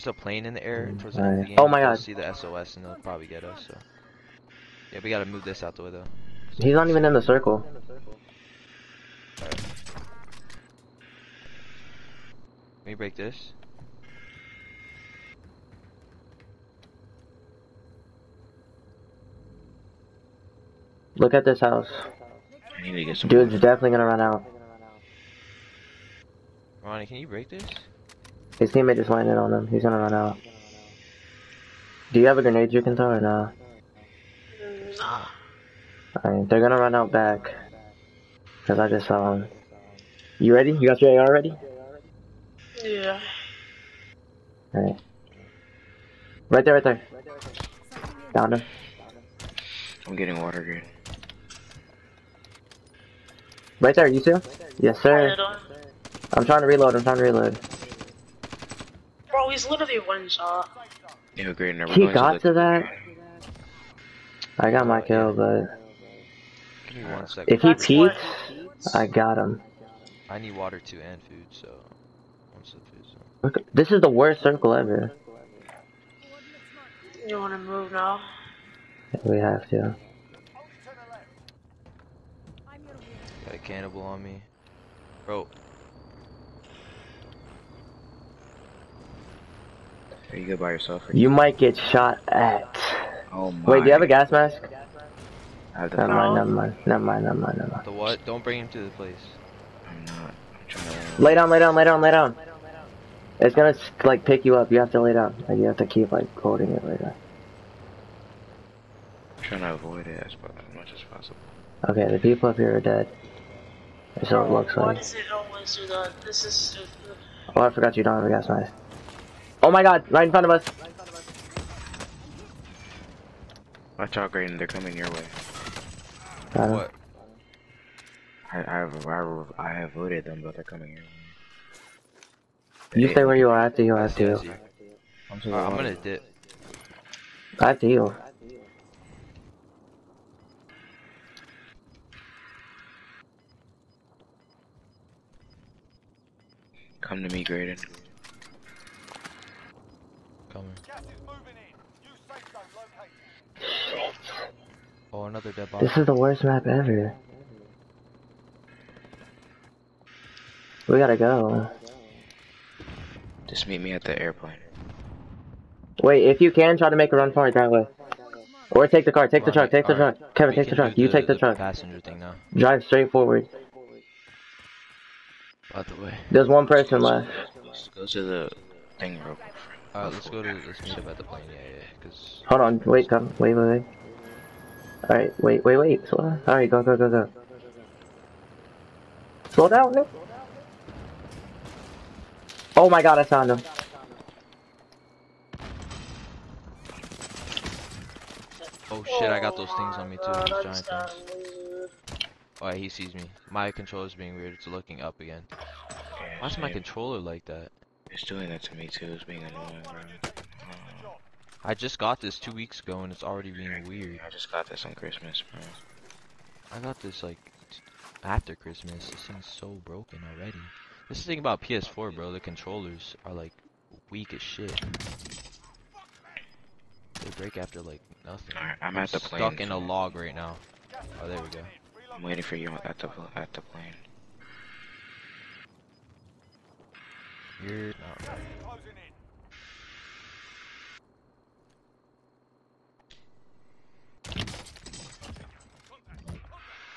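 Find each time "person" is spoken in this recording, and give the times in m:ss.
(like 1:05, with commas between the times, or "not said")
2:56.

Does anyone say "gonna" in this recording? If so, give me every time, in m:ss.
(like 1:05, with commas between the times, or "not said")
0:23, 0:29, 0:36, 1:43, 2:15.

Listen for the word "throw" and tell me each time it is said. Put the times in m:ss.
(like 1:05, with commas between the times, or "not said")
0:32.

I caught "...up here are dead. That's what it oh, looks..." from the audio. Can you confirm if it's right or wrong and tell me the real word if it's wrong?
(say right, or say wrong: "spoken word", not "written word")
right.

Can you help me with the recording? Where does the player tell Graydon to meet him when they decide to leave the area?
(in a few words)
The airplane.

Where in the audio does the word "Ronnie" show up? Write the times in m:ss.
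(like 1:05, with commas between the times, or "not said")
0:26.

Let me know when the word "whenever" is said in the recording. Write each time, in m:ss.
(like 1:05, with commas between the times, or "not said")
not said.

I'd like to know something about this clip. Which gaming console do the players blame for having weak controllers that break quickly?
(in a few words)
PS4.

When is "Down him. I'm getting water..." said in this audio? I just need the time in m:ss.
0:48.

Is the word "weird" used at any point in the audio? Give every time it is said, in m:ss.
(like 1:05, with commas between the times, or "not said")
3:24, 3:33.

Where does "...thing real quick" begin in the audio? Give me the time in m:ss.
2:58.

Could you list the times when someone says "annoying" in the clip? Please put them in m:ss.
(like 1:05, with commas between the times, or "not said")
3:29.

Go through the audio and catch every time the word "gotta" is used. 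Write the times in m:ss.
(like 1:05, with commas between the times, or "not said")
0:05, 2:40.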